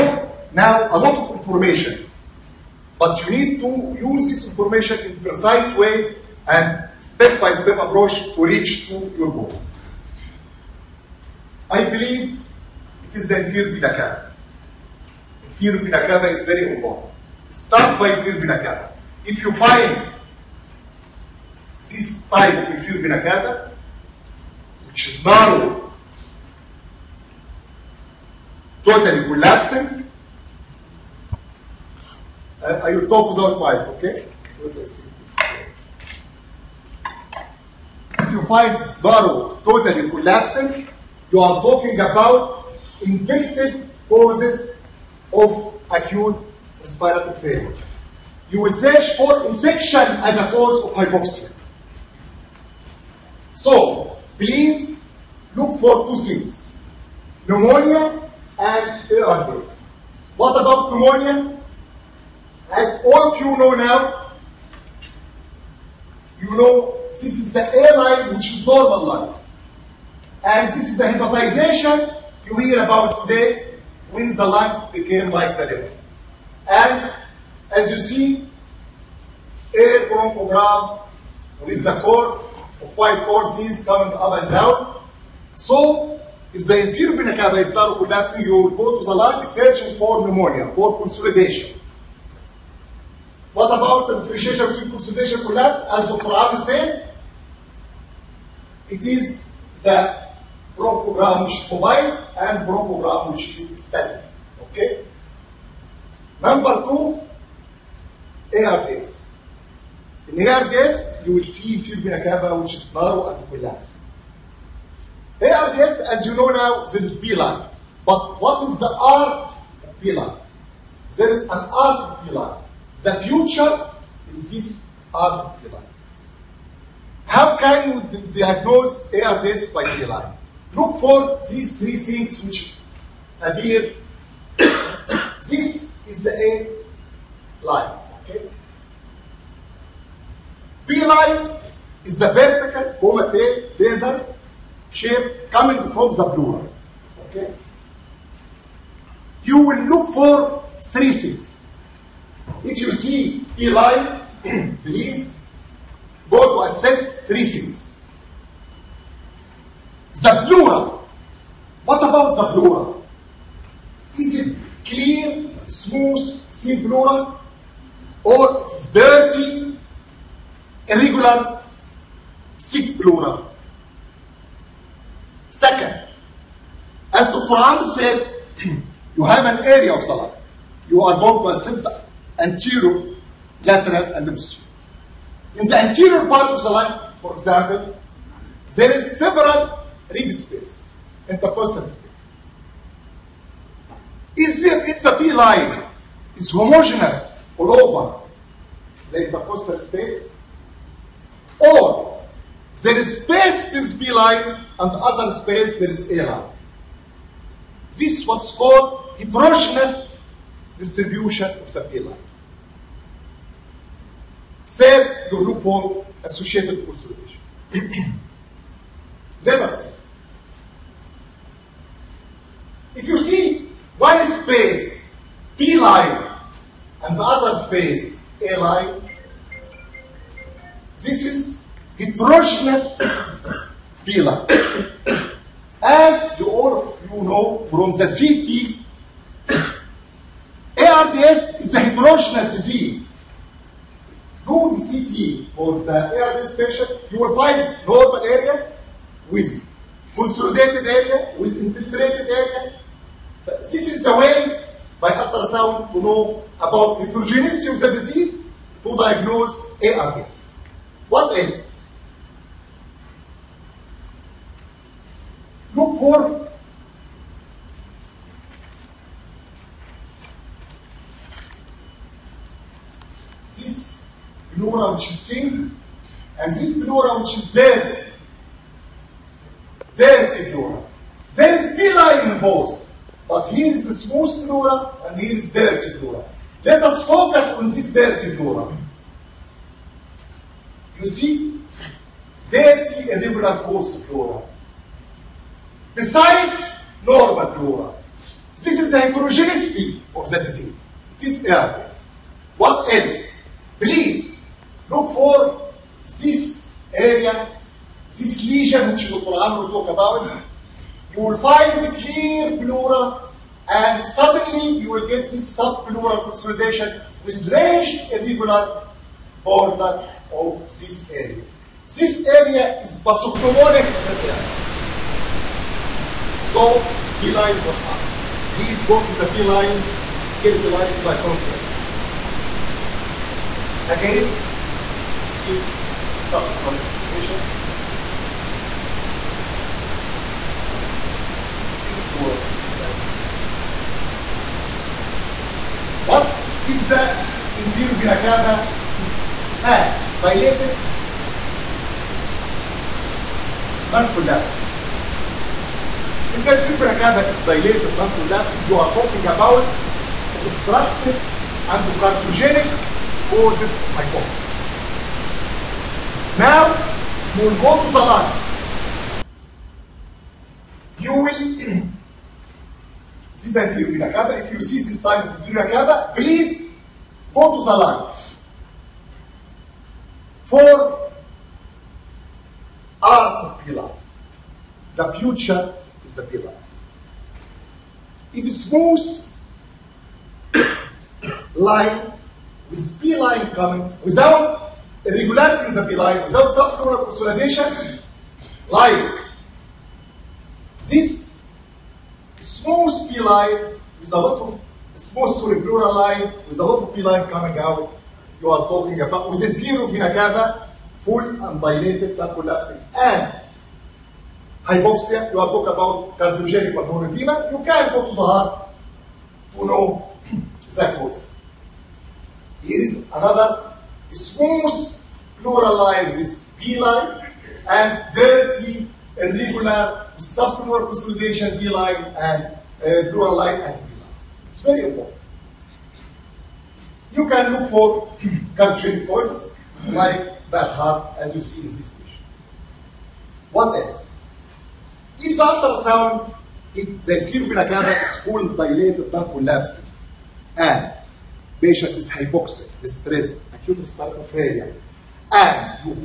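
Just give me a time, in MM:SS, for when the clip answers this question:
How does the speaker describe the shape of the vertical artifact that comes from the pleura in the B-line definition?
02:22.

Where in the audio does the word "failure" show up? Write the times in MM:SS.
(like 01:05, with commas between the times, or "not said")
00:47, 07:34.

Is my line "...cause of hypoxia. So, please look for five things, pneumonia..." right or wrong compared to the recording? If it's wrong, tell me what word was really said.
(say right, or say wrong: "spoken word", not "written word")
wrong: "two", not "five".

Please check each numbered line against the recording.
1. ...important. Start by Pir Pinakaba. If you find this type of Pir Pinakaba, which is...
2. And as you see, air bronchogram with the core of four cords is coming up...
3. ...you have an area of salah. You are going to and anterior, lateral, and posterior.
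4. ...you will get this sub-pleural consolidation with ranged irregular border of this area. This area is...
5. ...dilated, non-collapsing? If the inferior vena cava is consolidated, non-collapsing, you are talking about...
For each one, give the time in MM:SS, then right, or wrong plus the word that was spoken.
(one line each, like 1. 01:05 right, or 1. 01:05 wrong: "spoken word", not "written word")
1. 00:16 right
2. 01:16 wrong: "five", not "four"
3. 02:59 right
4. 05:14 right
5. 05:50 wrong: "dilated", not "consolidated".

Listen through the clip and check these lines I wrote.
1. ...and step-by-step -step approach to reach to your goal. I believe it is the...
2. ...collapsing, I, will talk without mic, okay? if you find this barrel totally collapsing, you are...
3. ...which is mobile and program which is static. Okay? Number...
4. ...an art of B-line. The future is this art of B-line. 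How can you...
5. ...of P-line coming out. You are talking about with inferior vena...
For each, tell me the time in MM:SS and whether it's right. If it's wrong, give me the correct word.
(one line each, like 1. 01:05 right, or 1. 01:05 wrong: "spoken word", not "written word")
1. 00:06 right
2. 00:29 right
3. 01:41 right
4. 02:01 right
5. 06:46 right.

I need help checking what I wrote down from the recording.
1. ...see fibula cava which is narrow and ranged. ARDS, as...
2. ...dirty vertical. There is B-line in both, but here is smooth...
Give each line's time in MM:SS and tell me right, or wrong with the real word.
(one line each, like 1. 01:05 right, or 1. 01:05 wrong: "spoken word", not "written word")
1. 01:51 wrong: "collapsed", not "ranged"
2. 04:39 wrong: "plural", not "vertical".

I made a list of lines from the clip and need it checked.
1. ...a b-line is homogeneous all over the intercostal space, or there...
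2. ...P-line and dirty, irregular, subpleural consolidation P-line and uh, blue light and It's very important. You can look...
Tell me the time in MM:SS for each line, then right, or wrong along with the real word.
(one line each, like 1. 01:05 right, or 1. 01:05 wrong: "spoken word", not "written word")
1. 03:15 right
2. 07:06 right.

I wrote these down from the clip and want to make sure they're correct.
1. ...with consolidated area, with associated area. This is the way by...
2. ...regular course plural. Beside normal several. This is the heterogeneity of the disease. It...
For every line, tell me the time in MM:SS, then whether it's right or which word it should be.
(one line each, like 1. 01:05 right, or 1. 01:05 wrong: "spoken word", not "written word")
1. 04:09 wrong: "infiltrated", not "associated"
2. 04:53 wrong: "plural", not "several".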